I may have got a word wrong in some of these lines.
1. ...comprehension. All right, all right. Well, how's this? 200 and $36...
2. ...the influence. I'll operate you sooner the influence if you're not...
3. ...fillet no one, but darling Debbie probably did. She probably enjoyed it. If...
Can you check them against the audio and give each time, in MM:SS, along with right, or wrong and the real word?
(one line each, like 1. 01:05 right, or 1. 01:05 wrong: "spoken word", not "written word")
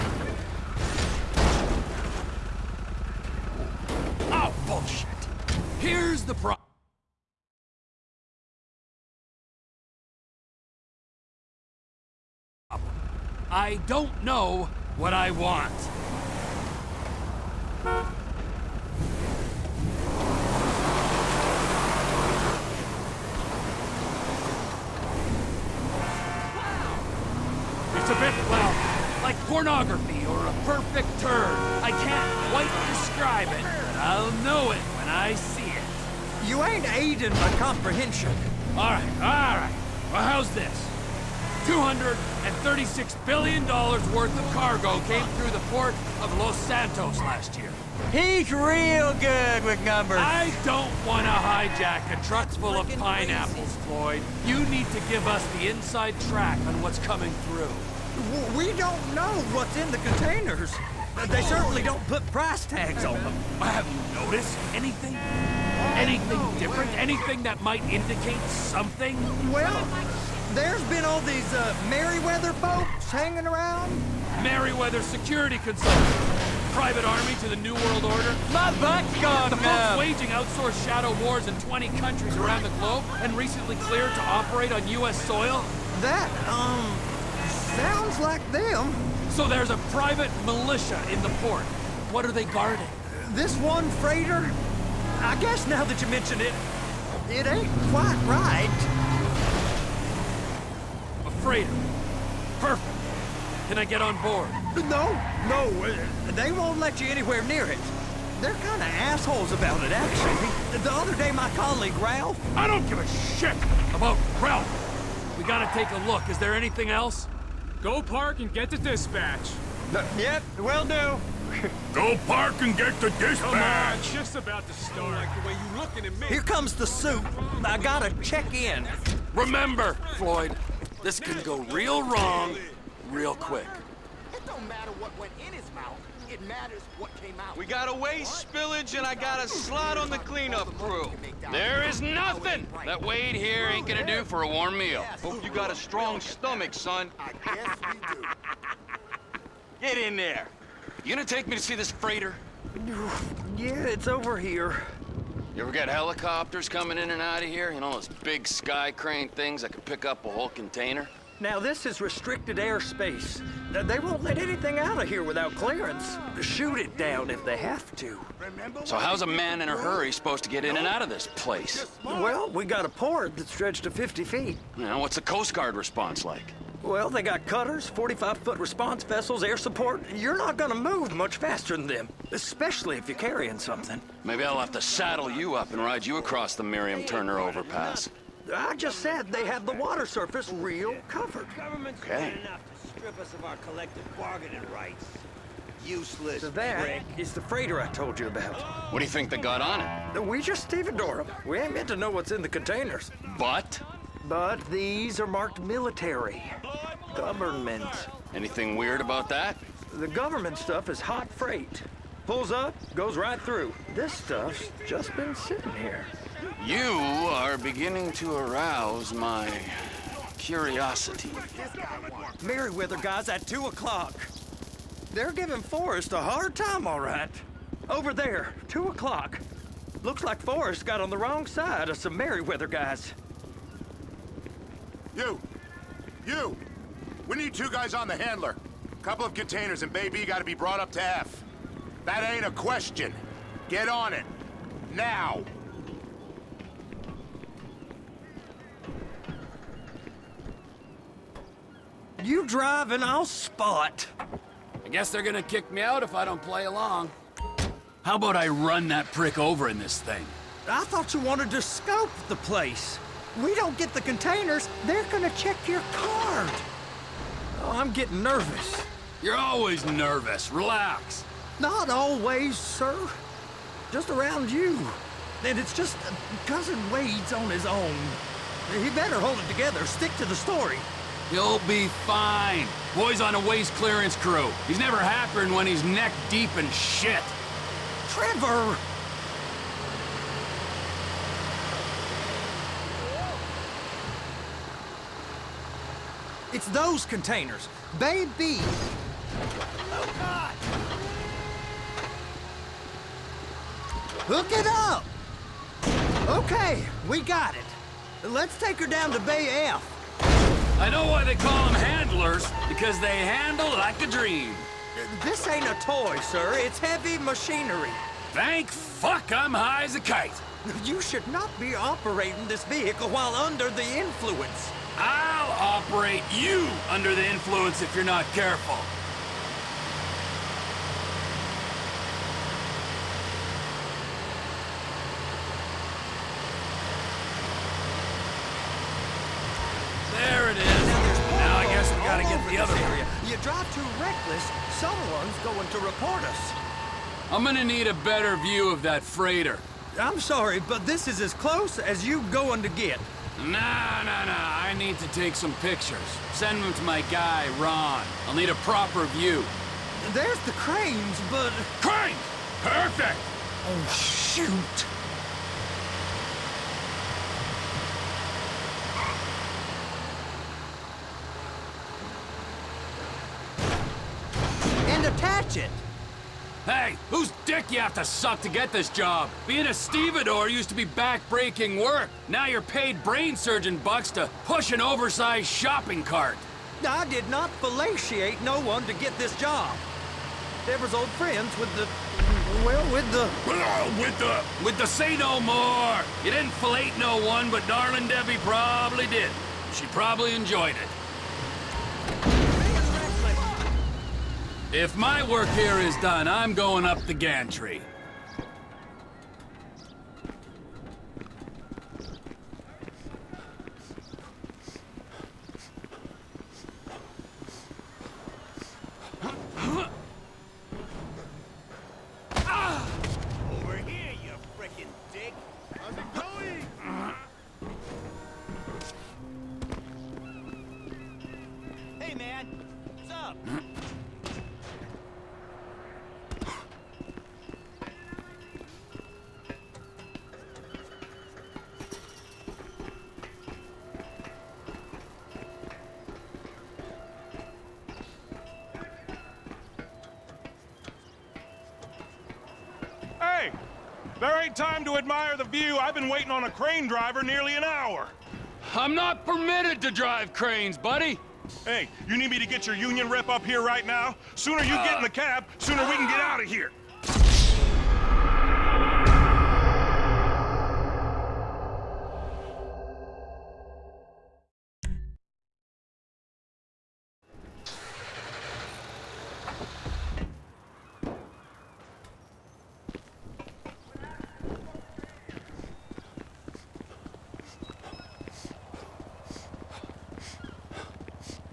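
1. 00:37 right
2. 05:23 wrong: "under", not "sooner"
3. 06:36 right.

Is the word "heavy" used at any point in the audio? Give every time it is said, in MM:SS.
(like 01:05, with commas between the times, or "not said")
05:16.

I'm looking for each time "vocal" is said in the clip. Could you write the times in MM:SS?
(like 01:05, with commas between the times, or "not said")
not said.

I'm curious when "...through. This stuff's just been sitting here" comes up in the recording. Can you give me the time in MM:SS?
03:33.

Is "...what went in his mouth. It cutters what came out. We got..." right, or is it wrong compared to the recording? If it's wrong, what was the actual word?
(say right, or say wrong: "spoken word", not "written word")
wrong: "matters", not "cutters".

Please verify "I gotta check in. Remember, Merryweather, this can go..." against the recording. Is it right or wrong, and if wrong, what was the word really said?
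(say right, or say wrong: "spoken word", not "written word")
wrong: "Floyd", not "Merryweather".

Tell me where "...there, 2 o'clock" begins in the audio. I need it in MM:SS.
03:48.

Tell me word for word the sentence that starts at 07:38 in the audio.
I'm not permitted to drive cranes, buddy.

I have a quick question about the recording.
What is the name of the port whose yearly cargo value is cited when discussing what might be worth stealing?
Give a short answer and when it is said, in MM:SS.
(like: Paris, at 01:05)
Los Santos, at 00:45.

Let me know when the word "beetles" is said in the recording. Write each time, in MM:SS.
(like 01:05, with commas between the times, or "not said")
not said.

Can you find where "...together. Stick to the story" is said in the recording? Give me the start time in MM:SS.
04:39.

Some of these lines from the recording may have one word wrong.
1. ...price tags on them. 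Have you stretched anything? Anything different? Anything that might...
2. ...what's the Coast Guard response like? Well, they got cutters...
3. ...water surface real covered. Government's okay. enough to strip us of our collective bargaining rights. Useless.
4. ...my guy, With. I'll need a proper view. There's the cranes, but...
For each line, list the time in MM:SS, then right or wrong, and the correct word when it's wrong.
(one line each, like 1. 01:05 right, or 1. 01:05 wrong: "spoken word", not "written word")
1. 01:02 wrong: "noticed", not "stretched"
2. 02:55 right
3. 03:09 right
4. 05:56 wrong: "Ron", not "With".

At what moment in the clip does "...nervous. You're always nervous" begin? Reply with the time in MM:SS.
04:28.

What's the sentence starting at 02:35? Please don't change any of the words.
You ever got helicopters coming in and out of here?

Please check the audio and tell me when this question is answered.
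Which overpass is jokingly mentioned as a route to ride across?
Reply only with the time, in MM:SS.
03:06.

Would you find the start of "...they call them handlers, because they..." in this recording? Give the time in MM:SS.
05:11.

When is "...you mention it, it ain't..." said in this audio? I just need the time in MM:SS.
01:36.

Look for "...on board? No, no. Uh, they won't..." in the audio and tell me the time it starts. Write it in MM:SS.
01:43.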